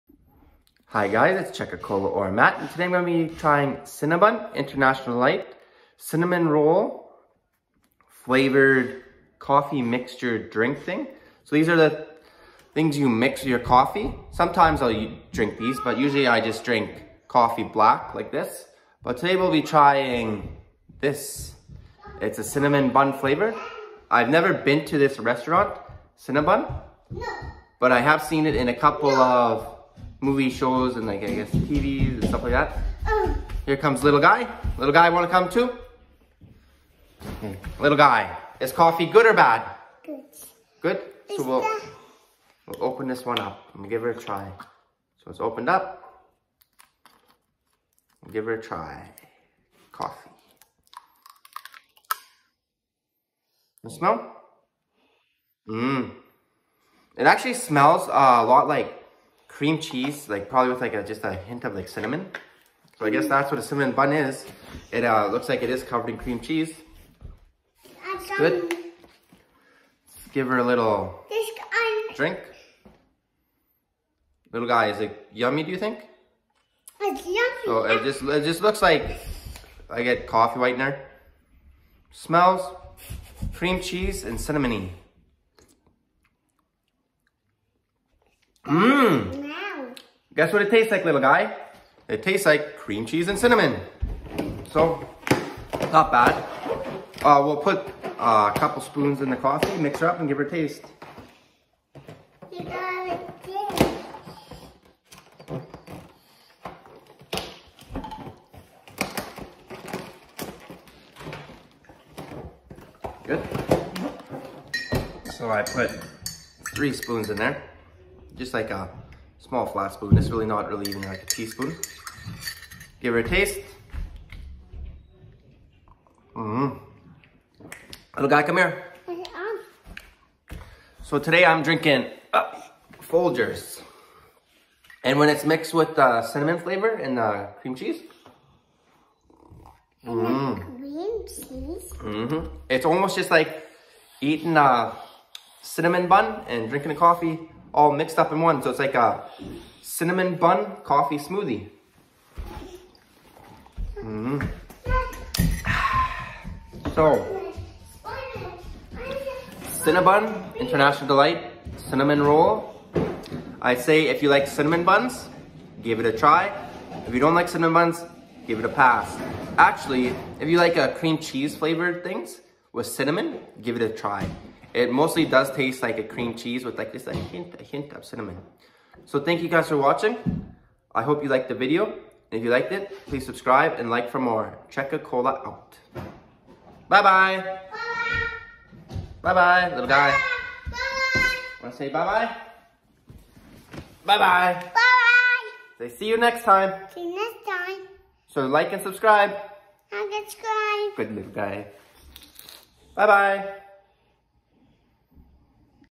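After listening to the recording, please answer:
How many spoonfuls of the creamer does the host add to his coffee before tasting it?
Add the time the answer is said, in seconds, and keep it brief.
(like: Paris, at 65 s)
3, at 116 s.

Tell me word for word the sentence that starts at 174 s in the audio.
It mostly does taste like a cream cheese with like just a hint, a hint of cinnamon.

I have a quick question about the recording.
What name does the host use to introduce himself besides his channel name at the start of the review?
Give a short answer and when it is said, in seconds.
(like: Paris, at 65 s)
Matt, at 2 s.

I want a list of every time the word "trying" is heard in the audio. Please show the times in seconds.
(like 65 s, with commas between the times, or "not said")
3 s, 19 s.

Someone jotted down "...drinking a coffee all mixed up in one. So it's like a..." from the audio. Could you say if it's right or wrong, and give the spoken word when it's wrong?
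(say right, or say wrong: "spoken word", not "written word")
right.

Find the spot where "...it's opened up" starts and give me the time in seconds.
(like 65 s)
45 s.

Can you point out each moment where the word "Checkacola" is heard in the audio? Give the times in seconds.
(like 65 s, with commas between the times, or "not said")
1 s, 184 s.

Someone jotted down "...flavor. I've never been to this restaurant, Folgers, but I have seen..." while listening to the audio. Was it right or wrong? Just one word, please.
wrong.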